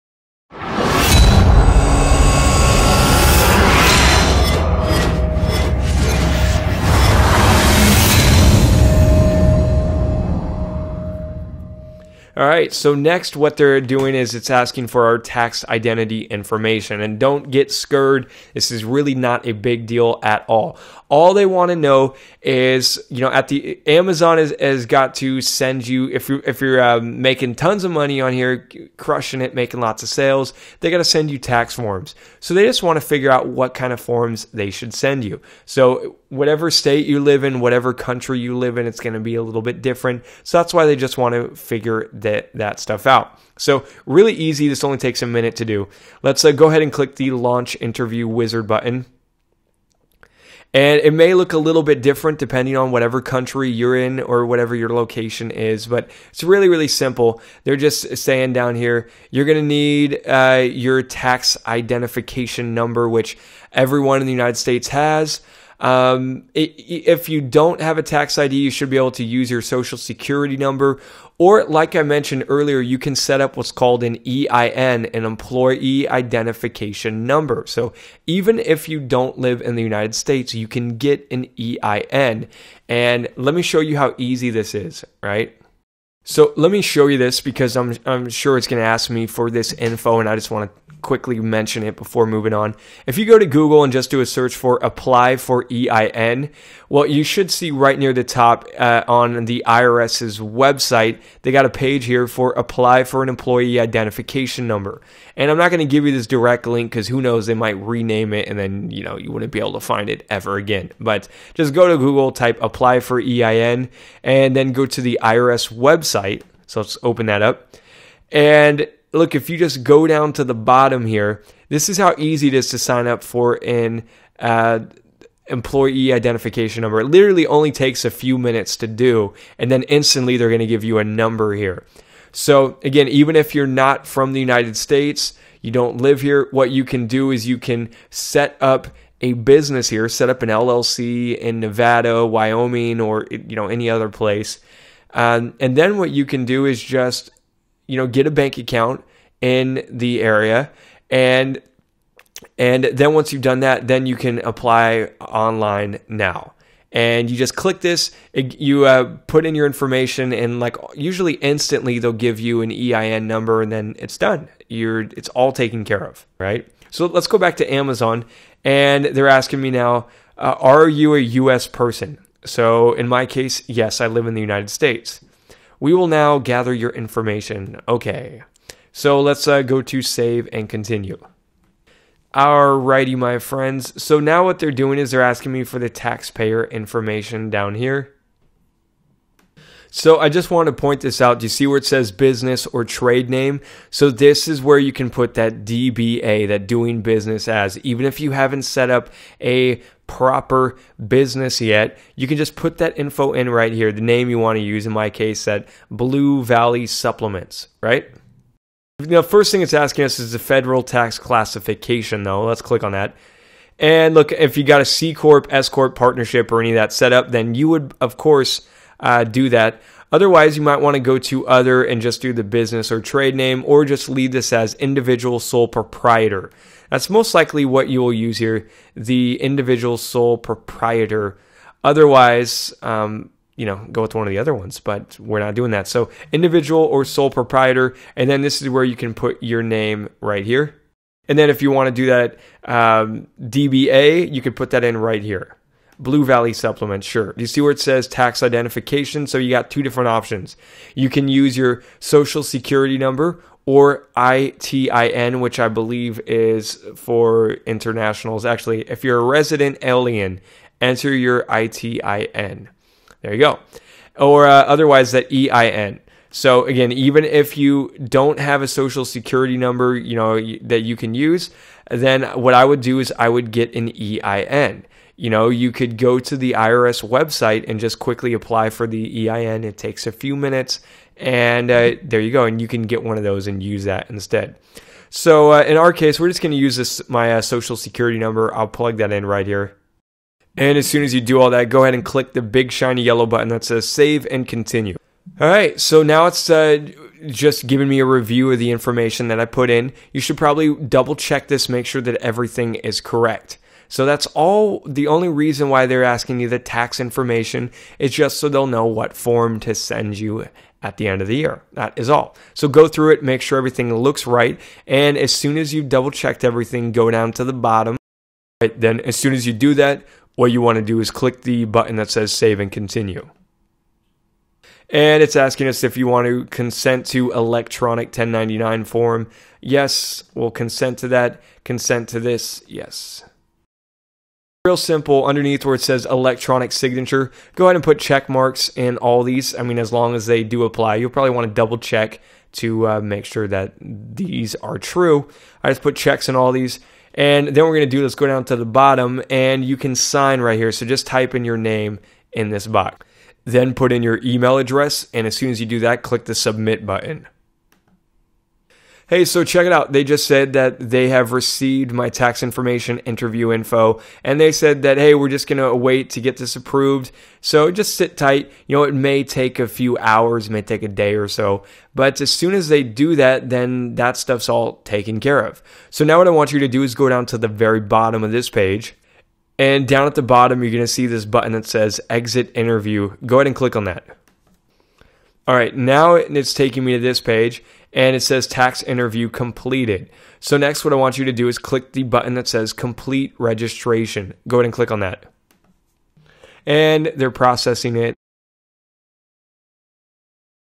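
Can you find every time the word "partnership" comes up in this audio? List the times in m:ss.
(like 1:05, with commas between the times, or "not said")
3:35.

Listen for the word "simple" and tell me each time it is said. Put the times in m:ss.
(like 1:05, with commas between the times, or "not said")
0:56, 5:34.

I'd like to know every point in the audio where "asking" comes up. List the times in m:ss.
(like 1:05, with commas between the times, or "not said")
0:14, 2:49, 3:05, 3:29, 5:06, 5:25.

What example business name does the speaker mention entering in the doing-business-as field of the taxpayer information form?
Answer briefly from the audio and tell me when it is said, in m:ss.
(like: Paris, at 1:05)
Blue Valley Supplements, at 3:25.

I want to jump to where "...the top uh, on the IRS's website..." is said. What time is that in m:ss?
1:38.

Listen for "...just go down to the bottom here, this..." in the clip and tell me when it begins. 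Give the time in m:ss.
1:59.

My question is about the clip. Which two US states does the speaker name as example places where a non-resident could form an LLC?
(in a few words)
Nevada, Wyoming.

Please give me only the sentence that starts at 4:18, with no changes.
Actually, if you're a resident alien, enter your ITIN.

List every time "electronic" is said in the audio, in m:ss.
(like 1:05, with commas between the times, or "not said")
5:27, 5:36.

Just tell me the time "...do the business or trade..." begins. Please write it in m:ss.
3:42.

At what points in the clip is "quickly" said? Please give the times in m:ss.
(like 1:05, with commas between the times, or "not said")
1:31, 4:37.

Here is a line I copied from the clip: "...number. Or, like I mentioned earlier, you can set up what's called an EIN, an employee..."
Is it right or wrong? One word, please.
right.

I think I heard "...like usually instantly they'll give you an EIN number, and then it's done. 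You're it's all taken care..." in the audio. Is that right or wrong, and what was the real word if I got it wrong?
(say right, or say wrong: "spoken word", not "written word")
right.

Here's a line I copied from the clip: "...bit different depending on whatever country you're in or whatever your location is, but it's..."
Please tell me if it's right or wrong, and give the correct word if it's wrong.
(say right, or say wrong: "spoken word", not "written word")
right.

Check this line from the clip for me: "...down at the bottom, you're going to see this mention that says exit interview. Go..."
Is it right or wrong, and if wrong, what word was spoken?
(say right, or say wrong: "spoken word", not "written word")
wrong: "button", not "mention".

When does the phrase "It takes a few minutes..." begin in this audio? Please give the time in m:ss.
4:39.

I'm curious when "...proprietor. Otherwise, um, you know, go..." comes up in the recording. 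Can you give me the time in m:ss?
3:50.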